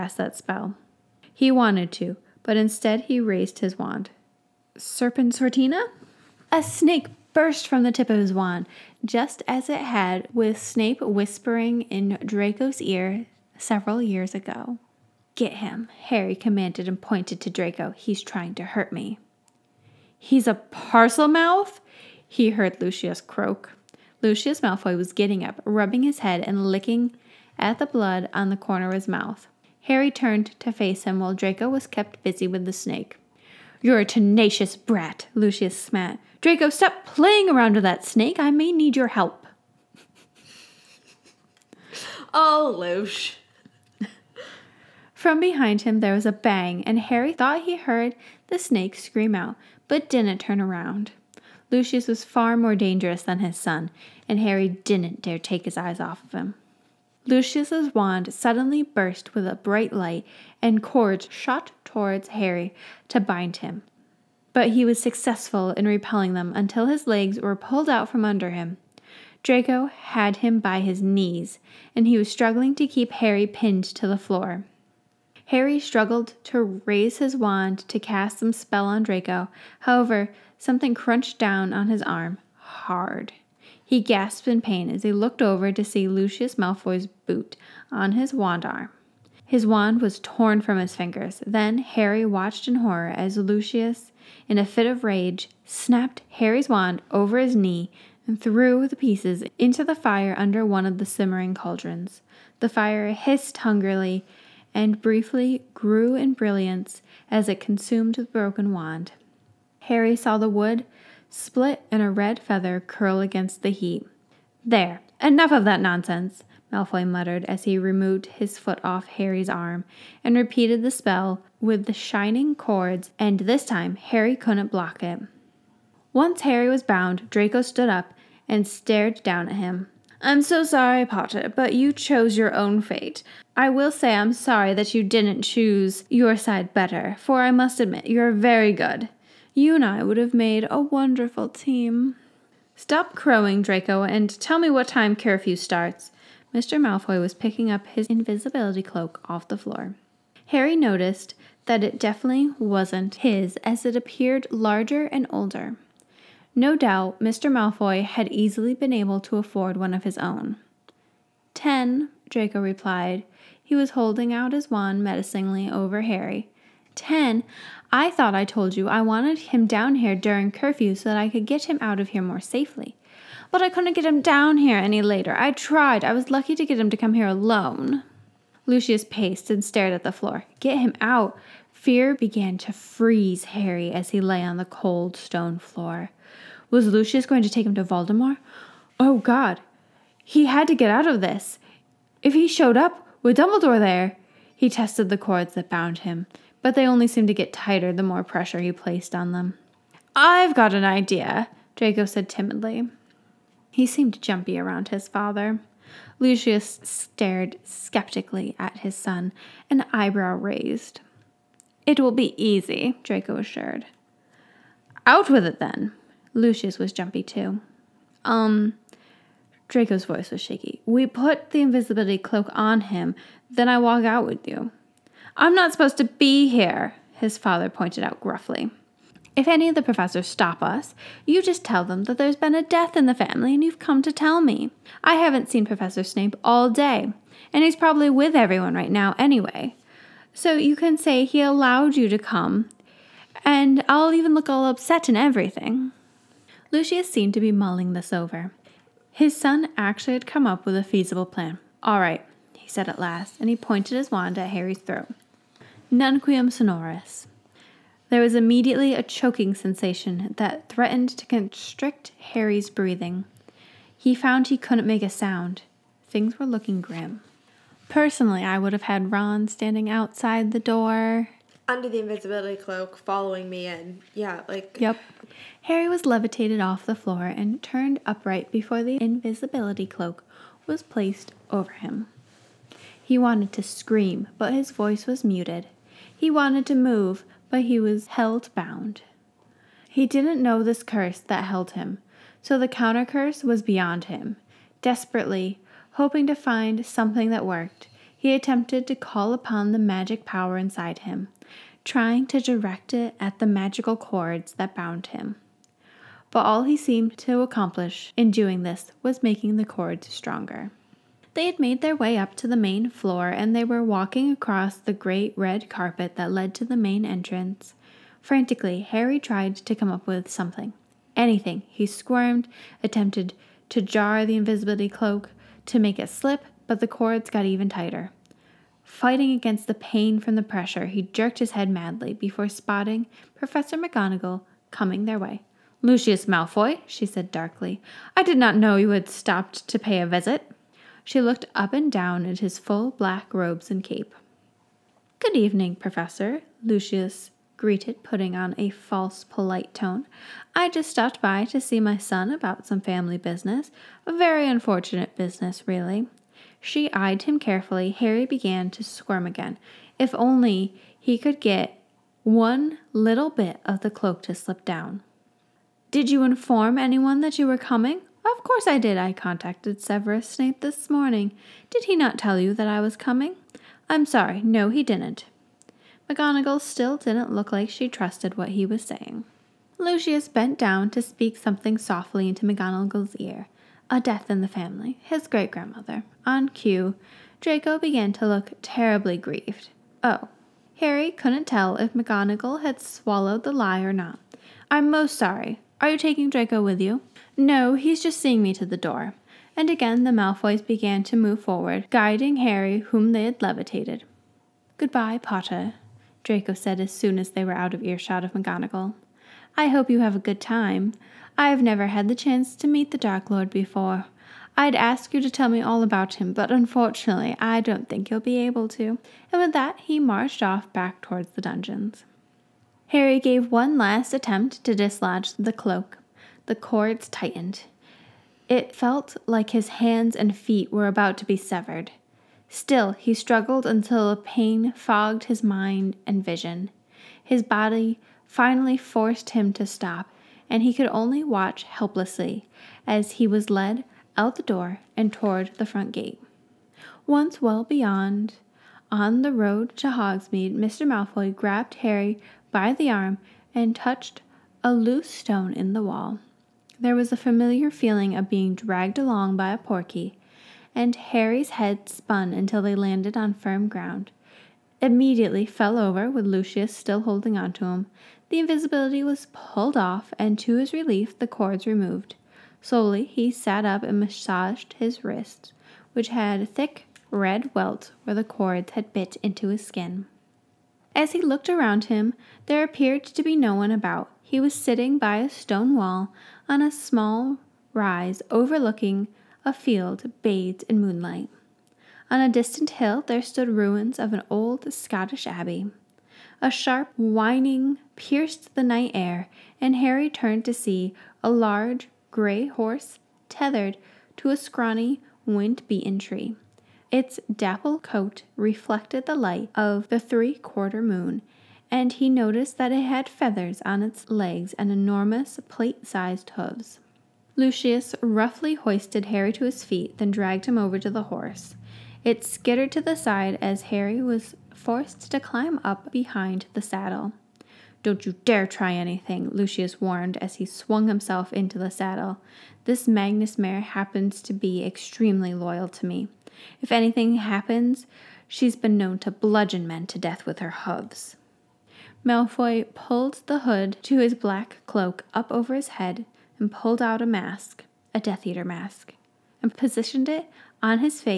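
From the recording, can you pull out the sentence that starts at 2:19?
You and I would have made a wonderful team.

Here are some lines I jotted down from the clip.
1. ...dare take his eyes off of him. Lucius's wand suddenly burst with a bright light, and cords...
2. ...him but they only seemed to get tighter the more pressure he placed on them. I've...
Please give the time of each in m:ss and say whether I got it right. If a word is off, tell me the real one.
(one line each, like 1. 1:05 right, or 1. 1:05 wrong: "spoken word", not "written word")
1. 0:55 right
2. 3:15 right.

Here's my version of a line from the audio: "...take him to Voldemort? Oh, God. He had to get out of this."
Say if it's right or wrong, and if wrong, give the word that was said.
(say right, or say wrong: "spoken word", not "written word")
right.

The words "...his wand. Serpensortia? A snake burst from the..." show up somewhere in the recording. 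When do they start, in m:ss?
0:03.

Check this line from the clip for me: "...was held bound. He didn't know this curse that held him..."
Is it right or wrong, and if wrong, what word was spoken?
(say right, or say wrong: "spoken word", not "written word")
right.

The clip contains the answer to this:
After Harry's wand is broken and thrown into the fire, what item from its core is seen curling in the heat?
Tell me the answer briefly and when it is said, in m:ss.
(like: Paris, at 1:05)
A red feather, at 1:52.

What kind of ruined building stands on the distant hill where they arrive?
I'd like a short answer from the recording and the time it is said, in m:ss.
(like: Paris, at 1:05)
An old Scottish abbey, at 8:14.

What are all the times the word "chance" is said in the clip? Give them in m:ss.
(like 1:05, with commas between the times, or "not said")
6:52.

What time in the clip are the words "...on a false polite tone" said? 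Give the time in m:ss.
5:48.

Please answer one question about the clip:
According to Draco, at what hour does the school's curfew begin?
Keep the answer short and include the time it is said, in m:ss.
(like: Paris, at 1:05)
10, at 2:41.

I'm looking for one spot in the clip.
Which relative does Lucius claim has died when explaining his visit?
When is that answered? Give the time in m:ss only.
6:25.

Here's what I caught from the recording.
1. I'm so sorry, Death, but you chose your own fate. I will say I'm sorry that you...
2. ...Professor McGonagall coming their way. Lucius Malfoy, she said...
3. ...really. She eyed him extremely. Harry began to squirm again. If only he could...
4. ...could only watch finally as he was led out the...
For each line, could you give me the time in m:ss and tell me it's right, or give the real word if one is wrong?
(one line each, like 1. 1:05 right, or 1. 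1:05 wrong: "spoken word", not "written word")
1. 2:10 wrong: "Potter", not "Death"
2. 5:33 right
3. 5:55 wrong: "carefully", not "extremely"
4. 7:20 wrong: "helplessly", not "finally".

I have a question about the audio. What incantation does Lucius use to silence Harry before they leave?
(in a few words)
Nunquam sonoris.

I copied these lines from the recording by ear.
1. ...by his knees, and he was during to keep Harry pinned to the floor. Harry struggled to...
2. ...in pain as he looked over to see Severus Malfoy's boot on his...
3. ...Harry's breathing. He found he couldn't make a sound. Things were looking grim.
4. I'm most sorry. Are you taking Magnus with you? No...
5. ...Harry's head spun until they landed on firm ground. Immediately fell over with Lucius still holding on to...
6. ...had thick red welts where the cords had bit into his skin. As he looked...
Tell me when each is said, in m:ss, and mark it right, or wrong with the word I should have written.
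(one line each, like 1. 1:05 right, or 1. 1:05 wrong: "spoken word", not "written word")
1. 1:10 wrong: "struggling", not "during"
2. 1:24 wrong: "Lucius", not "Severus"
3. 4:22 right
4. 6:34 wrong: "Draco", not "Magnus"
5. 7:40 right
6. 7:56 right.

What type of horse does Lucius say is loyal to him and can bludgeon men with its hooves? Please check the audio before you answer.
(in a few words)
Magnus mare.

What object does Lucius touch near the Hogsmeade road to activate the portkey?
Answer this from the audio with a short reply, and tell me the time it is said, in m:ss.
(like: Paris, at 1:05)
A loose stone, at 7:34.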